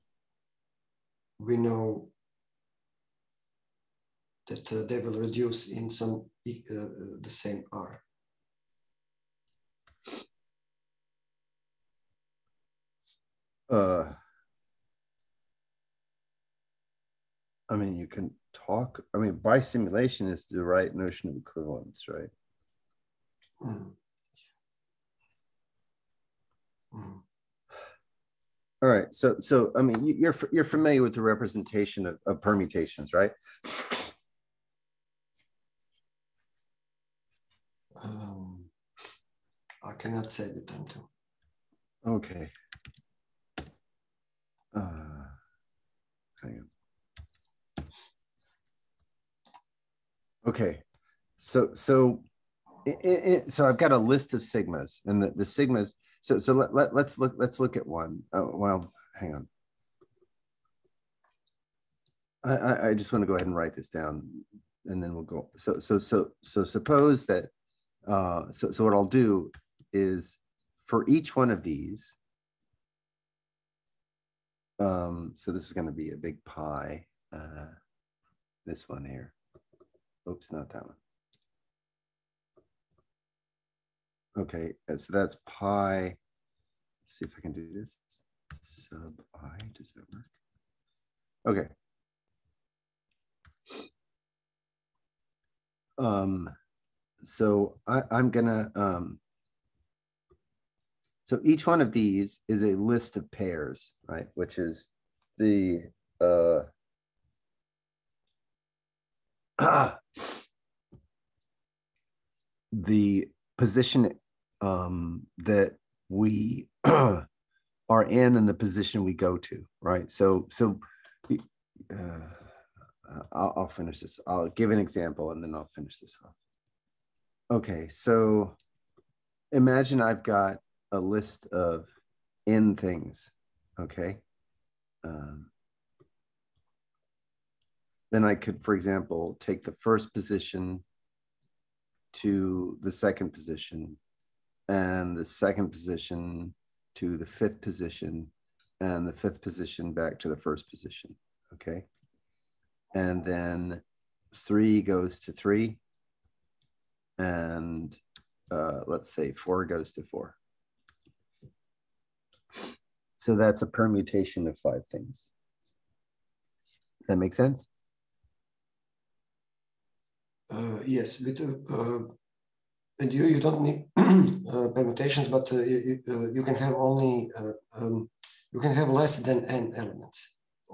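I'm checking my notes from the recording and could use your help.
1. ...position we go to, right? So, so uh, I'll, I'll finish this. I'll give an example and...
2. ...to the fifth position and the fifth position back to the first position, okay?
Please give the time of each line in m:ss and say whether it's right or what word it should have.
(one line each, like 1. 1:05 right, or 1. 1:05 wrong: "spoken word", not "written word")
1. 1:58 right
2. 2:26 right.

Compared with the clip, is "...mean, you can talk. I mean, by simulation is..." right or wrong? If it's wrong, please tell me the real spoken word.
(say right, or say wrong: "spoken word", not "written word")
right.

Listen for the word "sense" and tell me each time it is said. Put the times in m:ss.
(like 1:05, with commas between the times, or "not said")
2:47.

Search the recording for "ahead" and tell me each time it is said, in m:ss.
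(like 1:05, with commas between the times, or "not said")
1:03.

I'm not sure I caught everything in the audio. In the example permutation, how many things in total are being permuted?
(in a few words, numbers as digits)
5.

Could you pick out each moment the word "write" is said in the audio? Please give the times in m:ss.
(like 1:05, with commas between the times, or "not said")
1:03.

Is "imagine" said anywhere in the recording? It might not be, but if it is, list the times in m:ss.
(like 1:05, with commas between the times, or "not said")
2:09.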